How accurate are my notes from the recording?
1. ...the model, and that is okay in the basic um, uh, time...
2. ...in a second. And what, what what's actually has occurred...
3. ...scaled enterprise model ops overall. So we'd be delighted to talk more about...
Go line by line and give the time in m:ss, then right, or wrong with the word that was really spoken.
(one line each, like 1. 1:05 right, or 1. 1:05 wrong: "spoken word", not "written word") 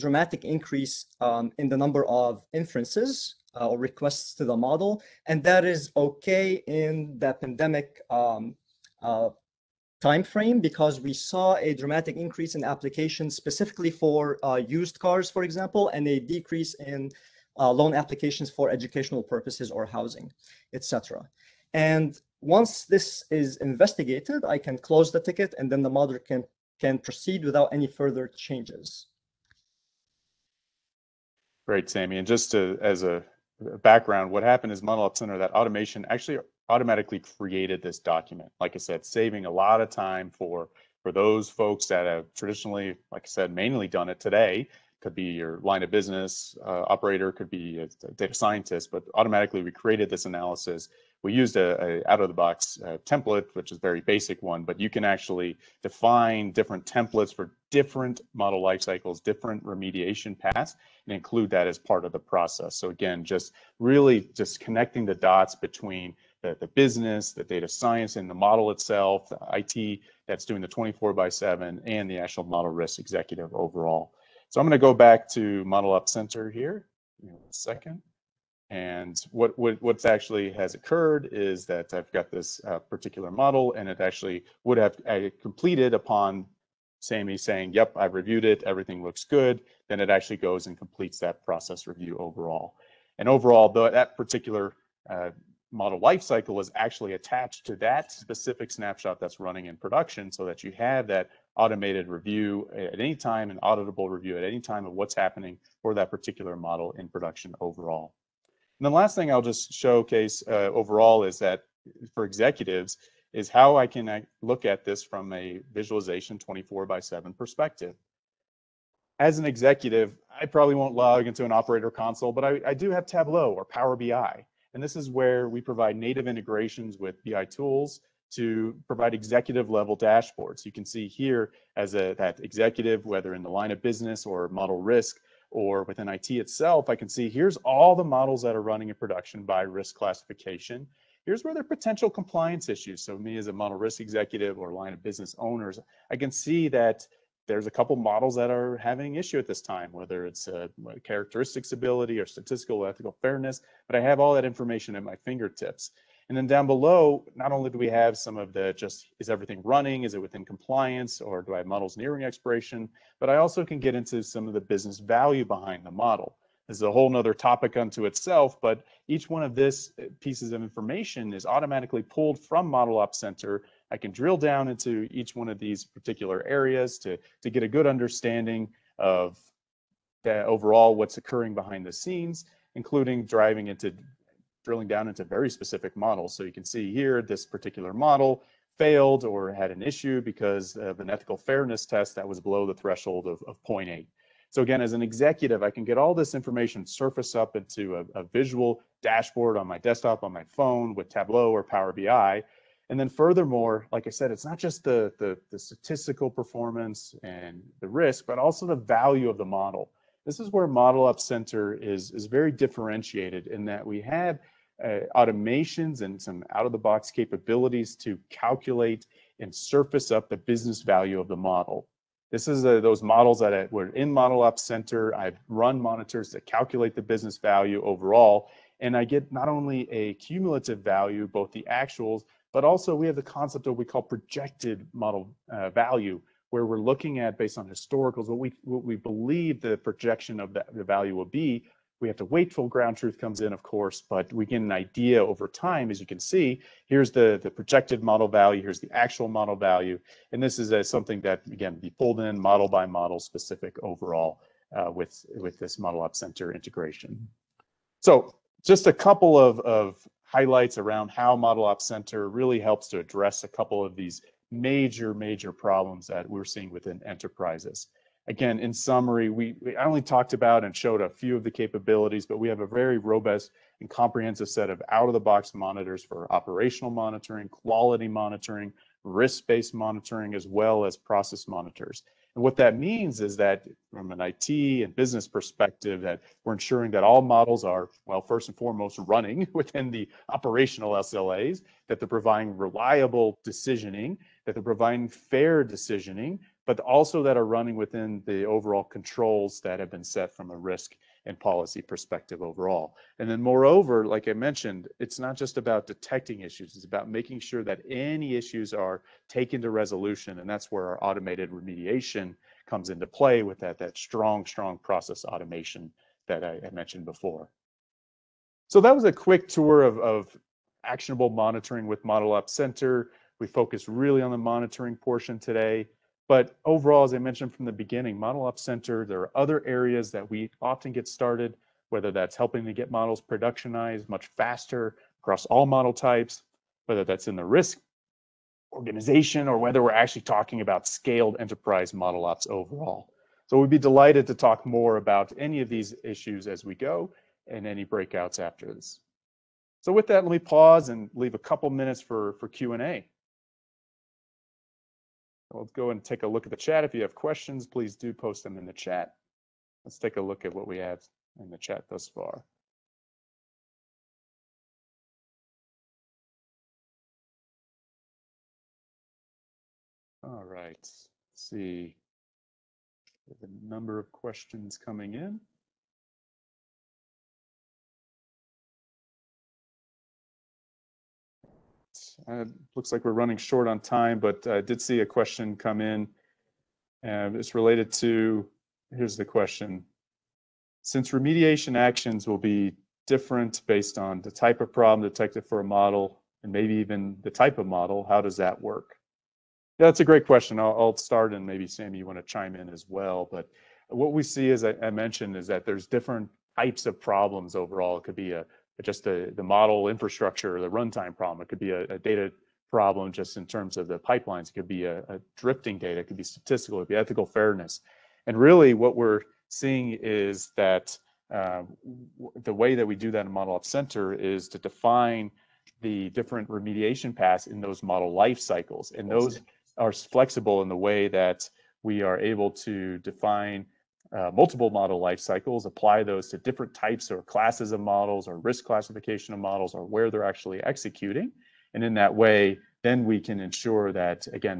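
1. 0:04 wrong: "pandemic", not "basic"
2. 1:17 right
3. 5:40 right.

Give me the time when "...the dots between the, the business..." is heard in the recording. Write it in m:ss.
1:05.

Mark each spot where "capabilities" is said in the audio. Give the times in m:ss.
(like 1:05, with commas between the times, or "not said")
3:37, 4:31.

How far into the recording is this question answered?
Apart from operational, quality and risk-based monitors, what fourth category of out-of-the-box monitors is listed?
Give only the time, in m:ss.
4:40.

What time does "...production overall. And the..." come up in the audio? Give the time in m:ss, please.
1:47.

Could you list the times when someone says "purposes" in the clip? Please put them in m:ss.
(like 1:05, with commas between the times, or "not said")
0:19.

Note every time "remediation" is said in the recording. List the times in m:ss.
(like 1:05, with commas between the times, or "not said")
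0:59, 5:11, 6:31, 7:06.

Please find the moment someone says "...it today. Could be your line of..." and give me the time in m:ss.
0:44.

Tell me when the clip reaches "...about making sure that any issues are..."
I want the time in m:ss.
5:06.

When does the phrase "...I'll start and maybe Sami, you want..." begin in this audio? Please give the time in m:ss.
6:40.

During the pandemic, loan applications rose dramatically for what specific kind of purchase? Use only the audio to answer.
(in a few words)
used cars.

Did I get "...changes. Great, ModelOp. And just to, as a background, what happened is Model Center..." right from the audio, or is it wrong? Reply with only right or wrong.
wrong.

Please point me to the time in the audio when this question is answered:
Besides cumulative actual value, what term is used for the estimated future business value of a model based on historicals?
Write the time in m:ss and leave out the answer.
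3:54.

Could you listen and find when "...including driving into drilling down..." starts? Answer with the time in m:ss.
3:02.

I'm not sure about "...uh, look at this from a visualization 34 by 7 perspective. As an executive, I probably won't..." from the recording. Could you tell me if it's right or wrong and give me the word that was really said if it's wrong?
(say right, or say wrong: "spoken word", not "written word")
wrong: "24", not "34".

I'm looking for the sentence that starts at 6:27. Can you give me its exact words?
And uh, it's related to, here's the question.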